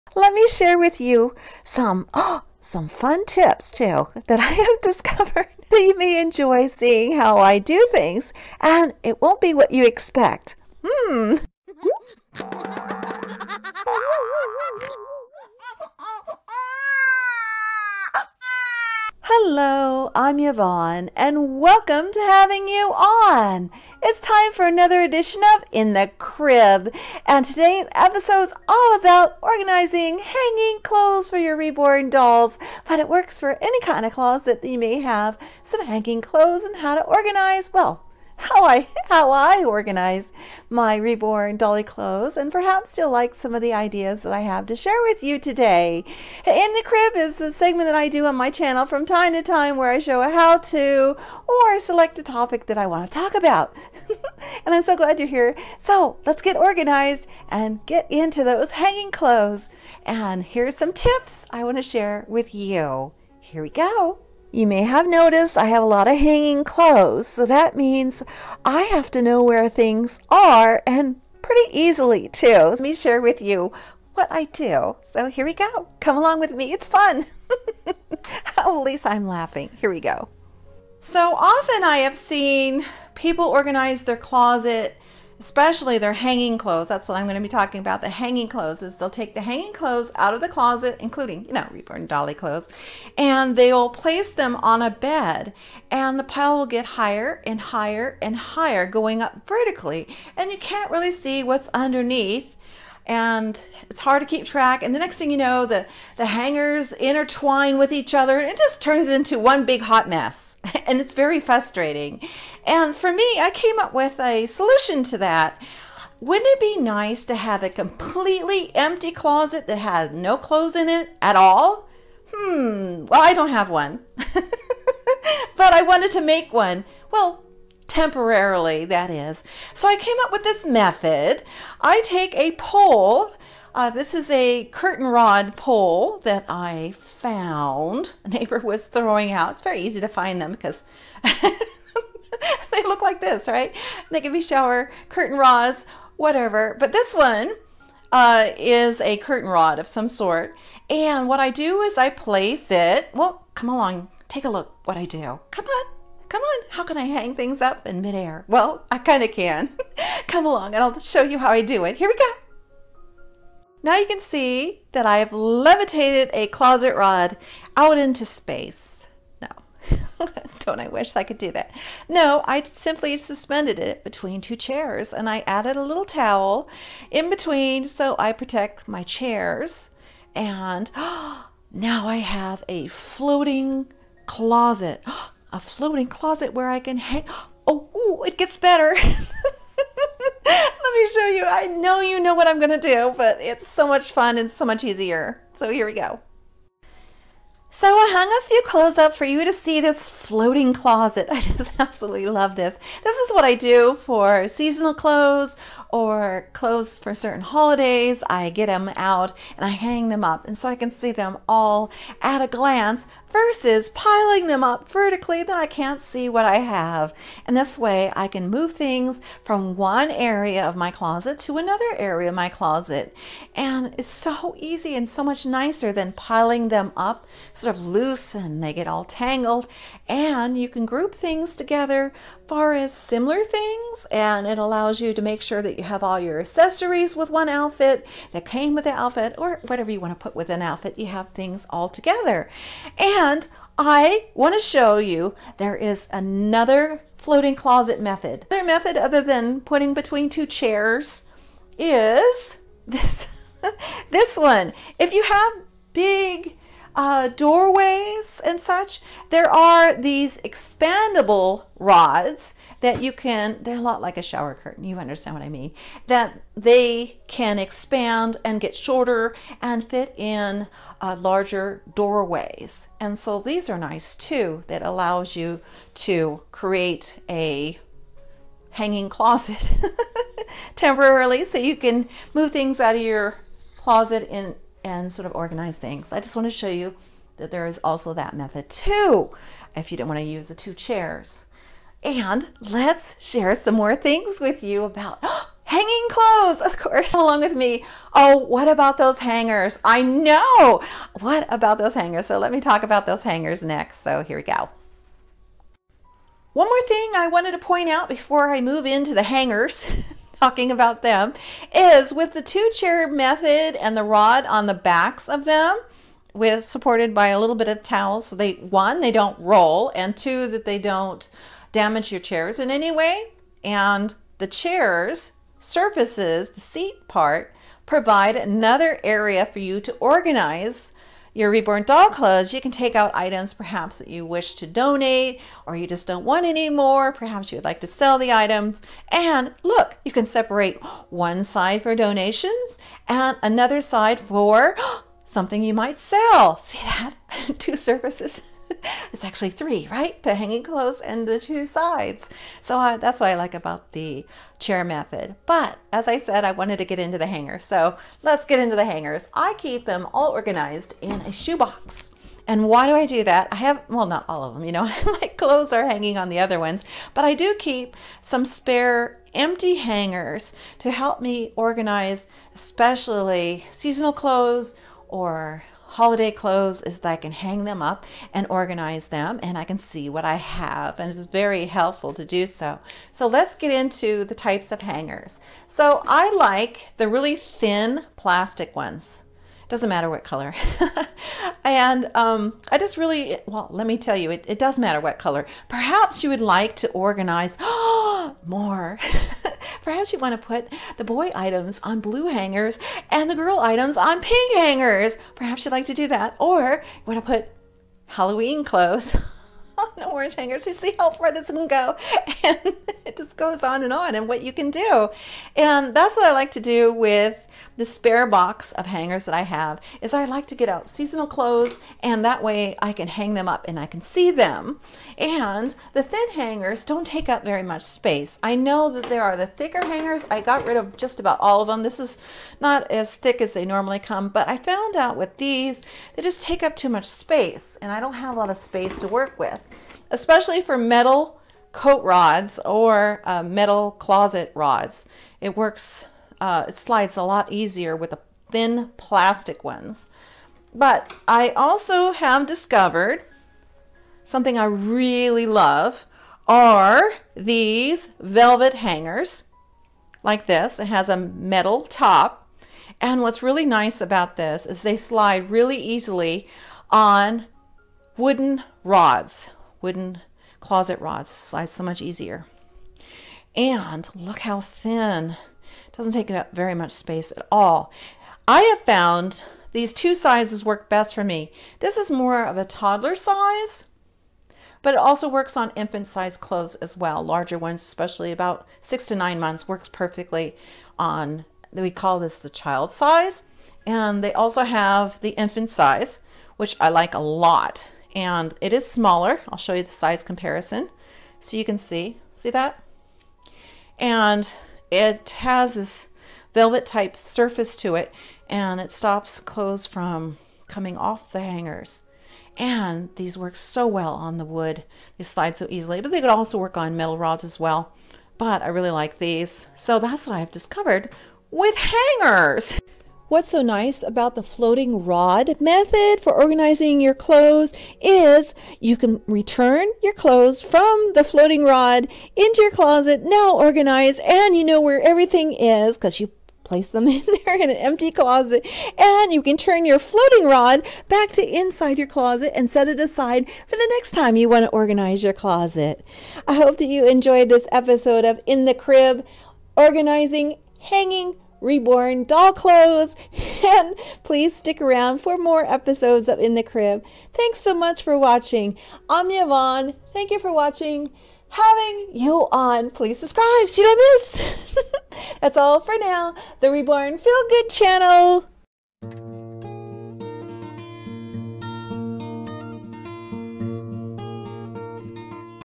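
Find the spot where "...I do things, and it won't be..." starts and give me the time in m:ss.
0:07.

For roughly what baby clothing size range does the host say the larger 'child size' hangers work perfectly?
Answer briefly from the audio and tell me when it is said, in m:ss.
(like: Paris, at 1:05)
6 to 9 months, at 8:08.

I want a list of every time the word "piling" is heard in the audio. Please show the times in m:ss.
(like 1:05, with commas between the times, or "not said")
3:33, 3:46.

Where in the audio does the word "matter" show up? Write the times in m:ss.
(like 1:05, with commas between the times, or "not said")
6:29, 6:34.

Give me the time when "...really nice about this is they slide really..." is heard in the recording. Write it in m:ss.
7:43.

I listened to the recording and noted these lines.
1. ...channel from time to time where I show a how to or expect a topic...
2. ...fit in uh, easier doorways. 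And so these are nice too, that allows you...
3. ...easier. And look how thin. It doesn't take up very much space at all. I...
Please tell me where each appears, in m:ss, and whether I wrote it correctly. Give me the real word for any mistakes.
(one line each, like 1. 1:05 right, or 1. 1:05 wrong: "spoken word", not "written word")
1. 0:48 wrong: "select", not "expect"
2. 4:29 wrong: "larger", not "easier"
3. 7:52 right.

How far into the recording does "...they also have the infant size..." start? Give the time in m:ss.
8:14.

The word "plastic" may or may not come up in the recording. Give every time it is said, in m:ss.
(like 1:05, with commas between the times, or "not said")
6:28, 7:28.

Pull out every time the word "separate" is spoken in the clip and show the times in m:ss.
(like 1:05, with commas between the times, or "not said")
5:40.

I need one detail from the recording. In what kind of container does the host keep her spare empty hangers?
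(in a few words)
A shoebox.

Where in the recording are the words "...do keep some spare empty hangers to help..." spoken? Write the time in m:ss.
6:07.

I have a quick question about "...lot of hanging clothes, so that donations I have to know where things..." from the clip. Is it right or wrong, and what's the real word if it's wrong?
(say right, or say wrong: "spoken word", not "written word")
wrong: "means", not "donations".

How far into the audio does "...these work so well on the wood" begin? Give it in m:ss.
8:33.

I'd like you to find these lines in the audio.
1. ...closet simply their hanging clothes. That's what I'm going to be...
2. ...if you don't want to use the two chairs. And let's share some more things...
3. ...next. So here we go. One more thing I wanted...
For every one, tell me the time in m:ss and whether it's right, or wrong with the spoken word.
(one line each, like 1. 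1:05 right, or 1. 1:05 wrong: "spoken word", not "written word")
1. 1:24 wrong: "especially", not "simply"
2. 4:49 right
3. 5:03 right.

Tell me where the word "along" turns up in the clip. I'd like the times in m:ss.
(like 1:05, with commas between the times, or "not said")
1:16, 2:33, 2:40, 4:57.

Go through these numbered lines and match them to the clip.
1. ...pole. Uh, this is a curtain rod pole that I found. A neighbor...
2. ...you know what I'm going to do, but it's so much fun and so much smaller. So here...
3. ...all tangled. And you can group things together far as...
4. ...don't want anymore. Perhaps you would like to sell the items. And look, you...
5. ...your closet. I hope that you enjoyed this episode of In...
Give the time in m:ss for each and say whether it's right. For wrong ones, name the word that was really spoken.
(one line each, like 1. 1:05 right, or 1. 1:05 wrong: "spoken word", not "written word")
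1. 2:12 right
2. 3:12 wrong: "easier", not "smaller"
3. 3:48 right
4. 5:36 right
5. 9:05 right.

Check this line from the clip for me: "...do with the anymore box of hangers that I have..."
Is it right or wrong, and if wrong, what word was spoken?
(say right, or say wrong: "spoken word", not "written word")
wrong: "spare", not "anymore".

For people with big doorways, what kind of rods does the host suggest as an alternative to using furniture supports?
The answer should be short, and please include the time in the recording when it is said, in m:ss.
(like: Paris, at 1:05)
Expandable rods, at 4:20.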